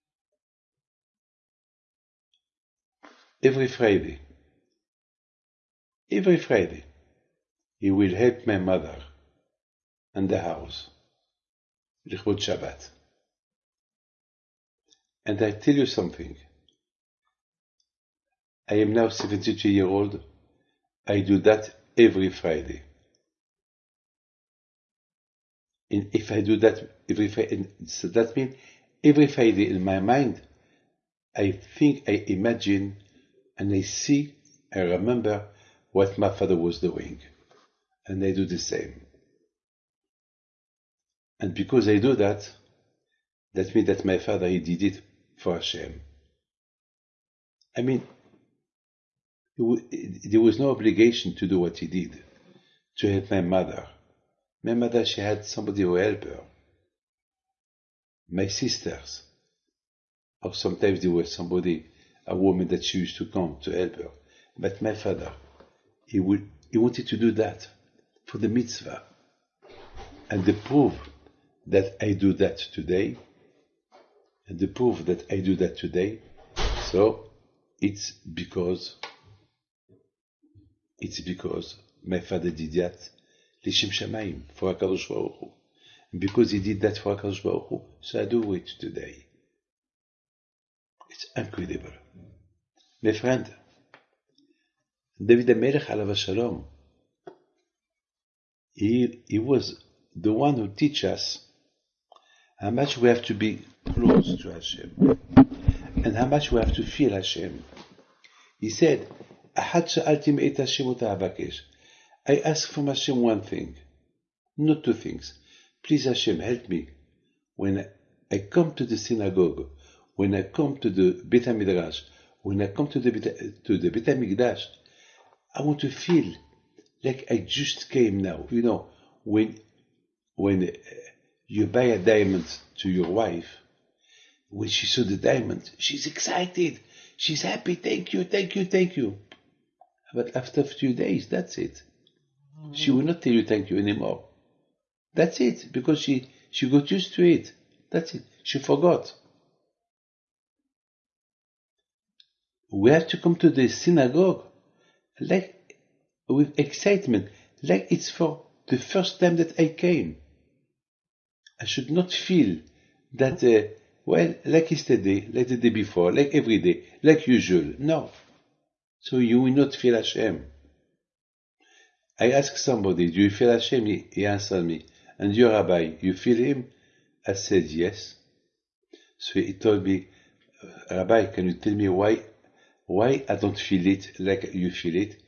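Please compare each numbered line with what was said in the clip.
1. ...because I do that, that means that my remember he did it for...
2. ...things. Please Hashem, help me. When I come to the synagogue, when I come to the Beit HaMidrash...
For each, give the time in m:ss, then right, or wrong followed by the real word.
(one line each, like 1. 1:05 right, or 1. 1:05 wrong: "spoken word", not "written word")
1. 0:41 wrong: "father", not "remember"
2. 1:54 right.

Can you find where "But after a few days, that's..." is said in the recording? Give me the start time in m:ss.
2:20.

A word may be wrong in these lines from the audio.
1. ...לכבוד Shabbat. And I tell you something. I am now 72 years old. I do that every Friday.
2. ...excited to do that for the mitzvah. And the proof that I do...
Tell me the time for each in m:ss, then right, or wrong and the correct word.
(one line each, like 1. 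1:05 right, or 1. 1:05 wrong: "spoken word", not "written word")
1. 0:12 right
2. 1:06 wrong: "wanted", not "excited".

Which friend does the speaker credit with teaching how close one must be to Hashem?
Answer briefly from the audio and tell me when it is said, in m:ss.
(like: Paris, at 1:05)
David Amelech, at 1:35.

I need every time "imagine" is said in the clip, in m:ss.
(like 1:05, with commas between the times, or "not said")
0:32.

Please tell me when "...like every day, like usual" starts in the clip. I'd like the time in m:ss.
2:46.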